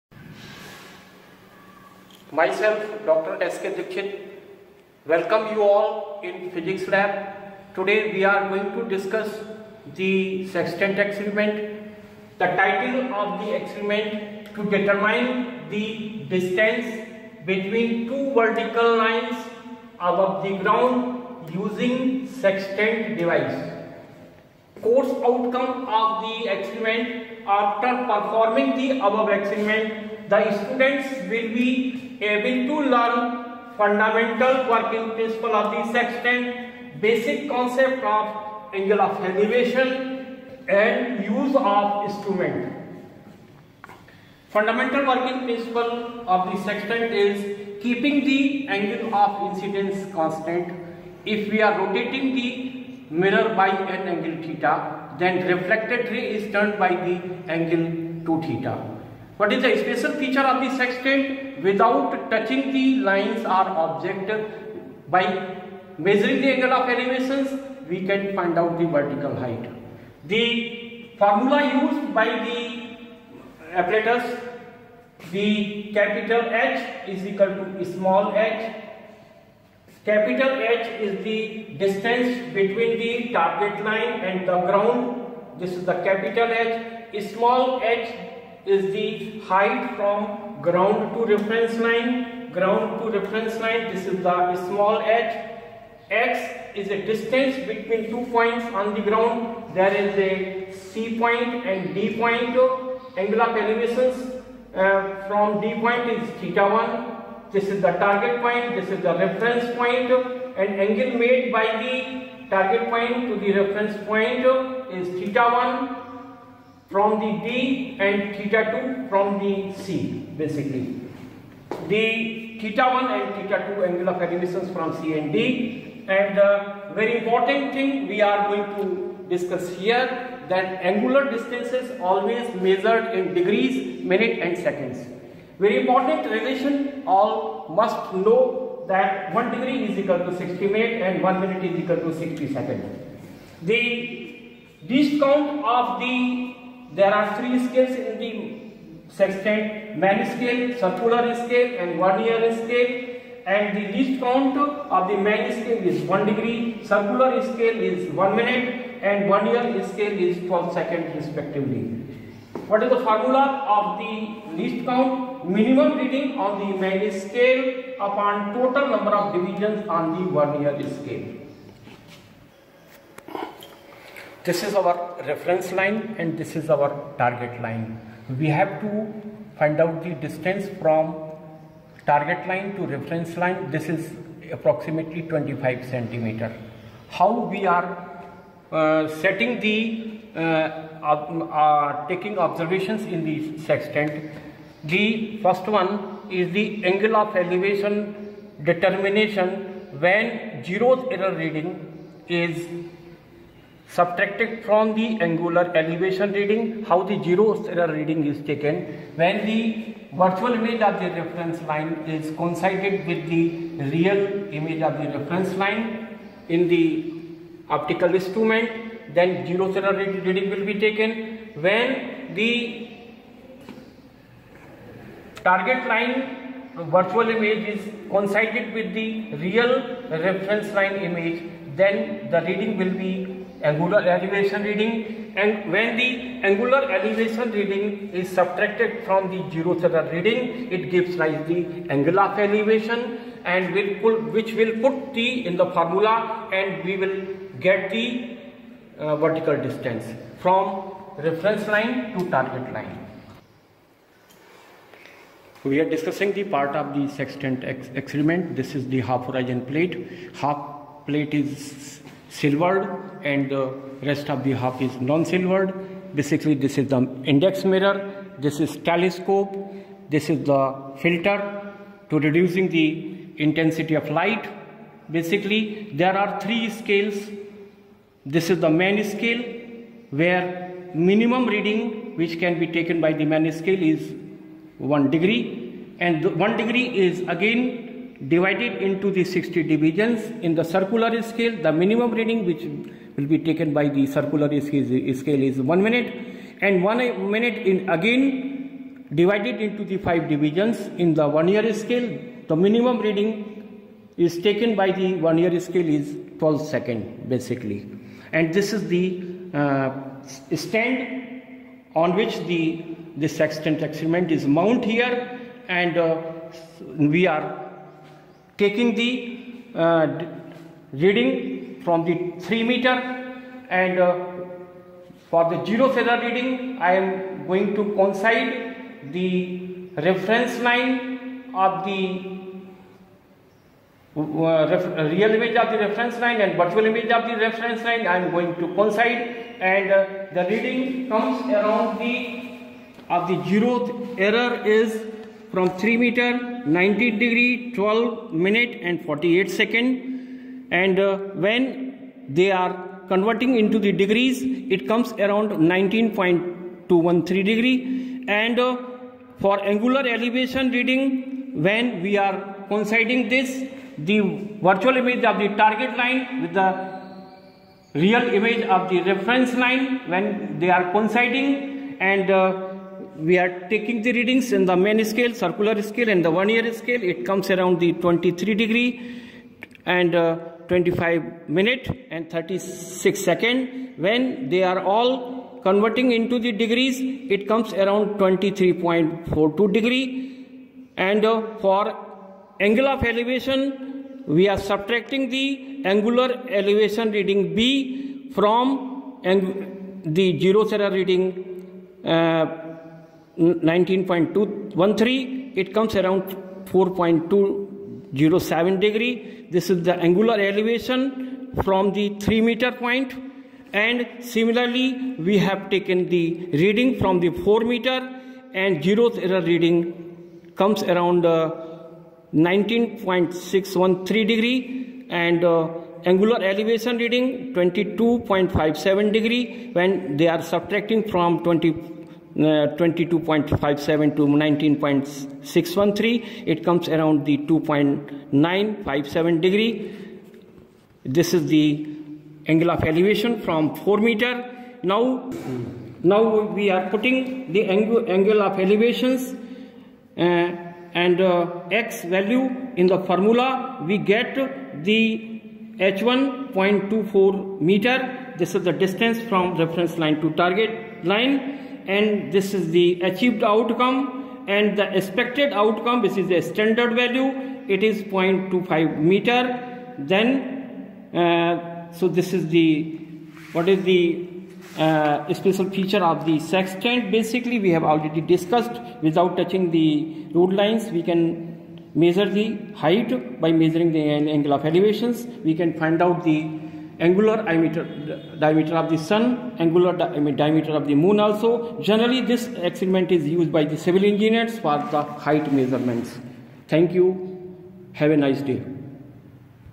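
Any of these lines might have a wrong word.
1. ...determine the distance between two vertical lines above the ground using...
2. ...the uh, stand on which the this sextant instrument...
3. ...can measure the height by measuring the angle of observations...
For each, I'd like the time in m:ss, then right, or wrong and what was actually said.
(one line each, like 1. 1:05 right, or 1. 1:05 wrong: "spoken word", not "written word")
1. 0:14 right
2. 5:08 wrong: "experiment", not "instrument"
3. 8:01 wrong: "elevations", not "observations".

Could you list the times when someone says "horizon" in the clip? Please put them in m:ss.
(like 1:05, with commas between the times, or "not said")
4:19.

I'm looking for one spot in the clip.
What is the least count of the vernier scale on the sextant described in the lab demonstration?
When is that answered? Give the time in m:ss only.
2:39.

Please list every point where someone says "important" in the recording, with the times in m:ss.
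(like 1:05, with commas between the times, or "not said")
2:07, 2:15.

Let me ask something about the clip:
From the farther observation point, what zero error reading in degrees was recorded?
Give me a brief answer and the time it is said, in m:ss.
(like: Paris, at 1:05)
19.613 degree, at 7:02.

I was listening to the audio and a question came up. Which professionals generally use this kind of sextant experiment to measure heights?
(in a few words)
civil engineers.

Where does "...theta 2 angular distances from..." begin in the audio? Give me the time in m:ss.
2:03.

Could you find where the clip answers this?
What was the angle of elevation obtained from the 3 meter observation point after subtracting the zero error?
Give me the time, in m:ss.
6:46.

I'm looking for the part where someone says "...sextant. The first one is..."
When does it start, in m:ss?
3:13.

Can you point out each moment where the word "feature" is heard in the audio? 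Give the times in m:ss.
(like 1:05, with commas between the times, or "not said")
1:00, 7:55.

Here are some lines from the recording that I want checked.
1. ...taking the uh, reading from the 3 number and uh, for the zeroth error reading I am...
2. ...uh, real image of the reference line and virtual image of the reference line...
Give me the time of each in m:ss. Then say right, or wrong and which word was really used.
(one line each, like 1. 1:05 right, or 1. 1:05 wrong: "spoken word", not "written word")
1. 5:18 wrong: "meter", not "number"
2. 5:32 right.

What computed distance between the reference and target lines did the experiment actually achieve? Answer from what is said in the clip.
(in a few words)
0.24 meter.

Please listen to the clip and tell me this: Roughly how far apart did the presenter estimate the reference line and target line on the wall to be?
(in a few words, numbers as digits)
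25 centimeter.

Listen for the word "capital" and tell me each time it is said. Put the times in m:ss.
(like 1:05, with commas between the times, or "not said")
1:15, 1:20, 1:26.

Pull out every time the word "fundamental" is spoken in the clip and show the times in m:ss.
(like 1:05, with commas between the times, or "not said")
0:33, 0:44.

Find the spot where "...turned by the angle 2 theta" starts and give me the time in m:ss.
0:56.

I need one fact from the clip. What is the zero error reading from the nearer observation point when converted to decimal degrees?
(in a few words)
19.213 degree.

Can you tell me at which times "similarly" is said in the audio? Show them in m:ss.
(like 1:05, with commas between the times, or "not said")
6:54.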